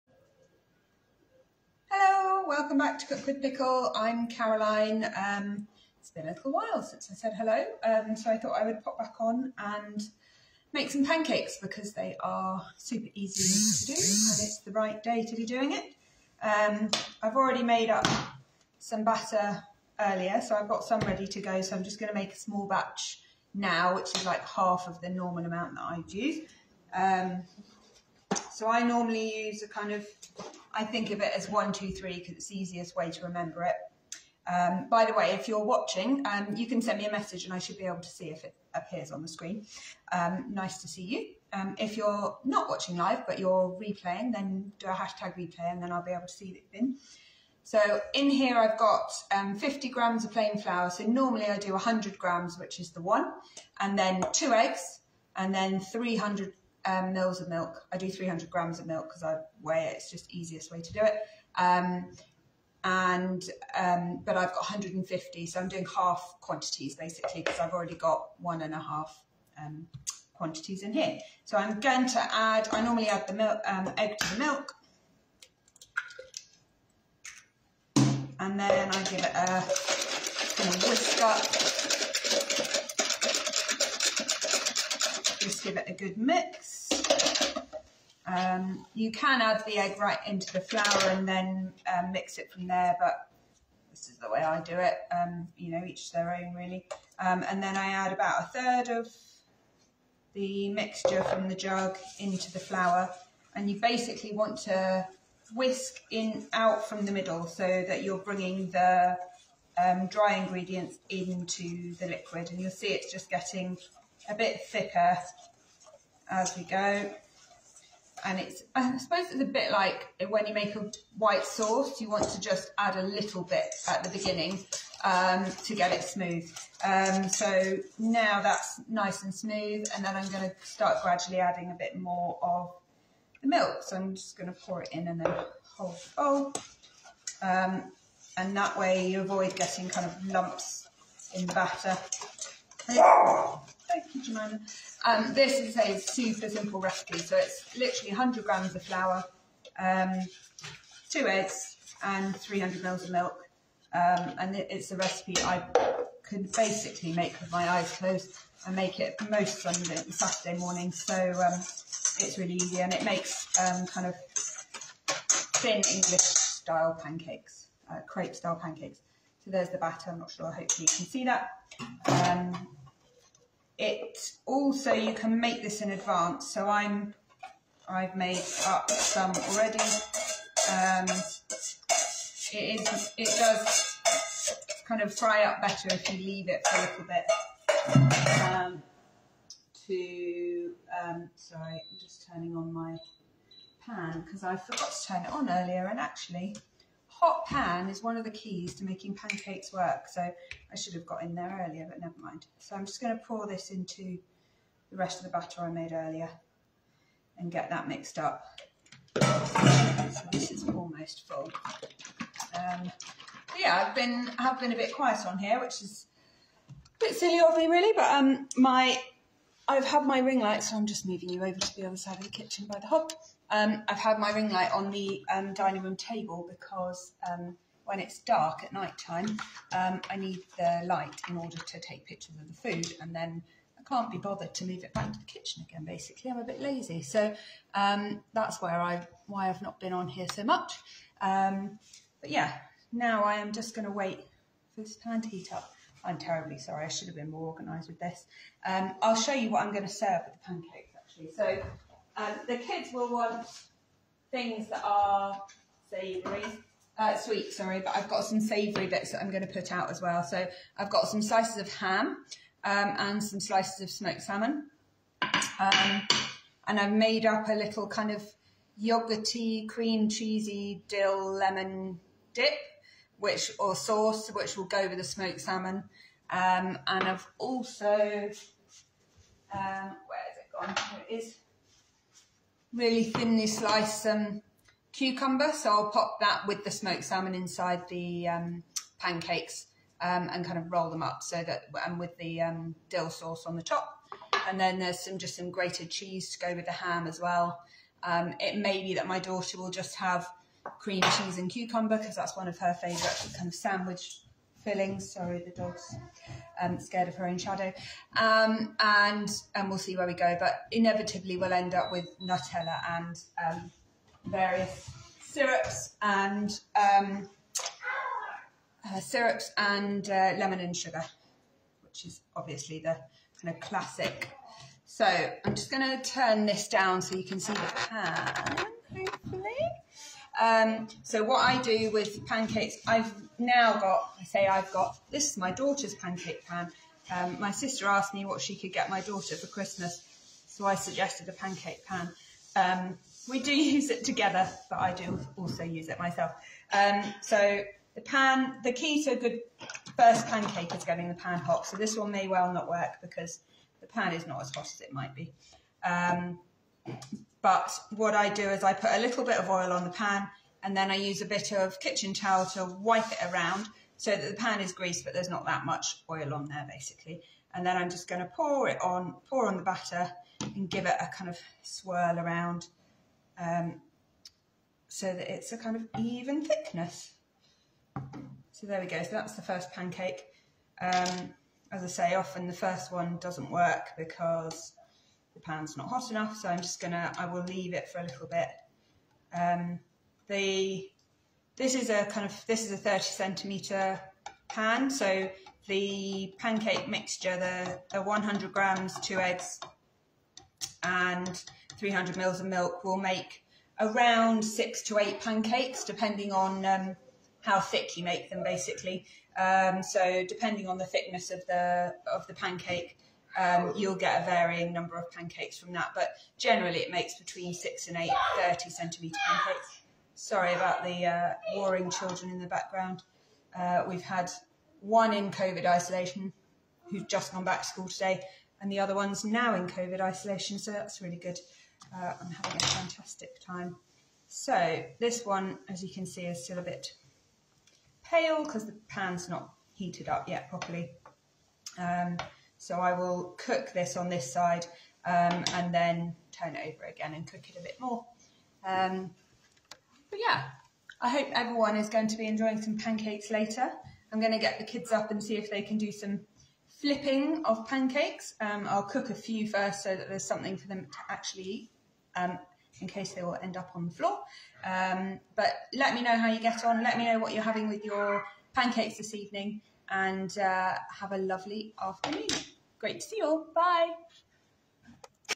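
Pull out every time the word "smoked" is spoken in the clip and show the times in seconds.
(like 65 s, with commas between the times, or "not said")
263 s, 275 s, 286 s.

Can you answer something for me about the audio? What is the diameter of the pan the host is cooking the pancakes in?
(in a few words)
30 centimetres.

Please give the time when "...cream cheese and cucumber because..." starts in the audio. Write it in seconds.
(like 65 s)
300 s.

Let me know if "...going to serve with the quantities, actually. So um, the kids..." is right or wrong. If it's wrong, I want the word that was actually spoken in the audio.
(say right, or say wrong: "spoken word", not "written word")
wrong: "pancakes", not "quantities".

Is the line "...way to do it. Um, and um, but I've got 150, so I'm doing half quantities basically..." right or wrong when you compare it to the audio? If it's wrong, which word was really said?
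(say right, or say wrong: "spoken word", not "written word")
right.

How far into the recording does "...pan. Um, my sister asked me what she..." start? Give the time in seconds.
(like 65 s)
336 s.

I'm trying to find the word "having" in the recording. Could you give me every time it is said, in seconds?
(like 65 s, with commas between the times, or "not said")
432 s, 467 s.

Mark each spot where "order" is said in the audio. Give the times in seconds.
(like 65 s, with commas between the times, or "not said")
231 s.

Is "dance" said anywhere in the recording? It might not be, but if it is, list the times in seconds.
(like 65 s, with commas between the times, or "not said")
not said.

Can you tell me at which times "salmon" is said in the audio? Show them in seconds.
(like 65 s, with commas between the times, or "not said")
264 s, 275 s, 287 s.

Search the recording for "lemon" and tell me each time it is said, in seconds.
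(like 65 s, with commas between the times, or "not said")
271 s, 320 s.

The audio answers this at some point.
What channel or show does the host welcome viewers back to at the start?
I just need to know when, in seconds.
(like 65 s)
3 s.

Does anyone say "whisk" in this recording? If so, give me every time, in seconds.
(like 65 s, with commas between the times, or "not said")
80 s, 105 s.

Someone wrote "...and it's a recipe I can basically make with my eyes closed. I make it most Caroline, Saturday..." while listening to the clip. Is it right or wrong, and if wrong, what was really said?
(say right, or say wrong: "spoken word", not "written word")
wrong: "Sunday", not "Caroline".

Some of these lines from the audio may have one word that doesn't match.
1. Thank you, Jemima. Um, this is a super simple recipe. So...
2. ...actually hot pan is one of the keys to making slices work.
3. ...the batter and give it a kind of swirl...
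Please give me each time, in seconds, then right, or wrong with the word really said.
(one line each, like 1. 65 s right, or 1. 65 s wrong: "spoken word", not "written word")
1. 143 s right
2. 195 s wrong: "pancakes", not "slices"
3. 369 s right.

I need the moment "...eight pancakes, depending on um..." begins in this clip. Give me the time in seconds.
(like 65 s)
404 s.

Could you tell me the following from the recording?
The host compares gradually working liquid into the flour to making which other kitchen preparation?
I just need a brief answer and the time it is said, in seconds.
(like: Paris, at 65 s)
a white sauce, at 120 s.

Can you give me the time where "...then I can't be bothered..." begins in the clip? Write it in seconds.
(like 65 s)
233 s.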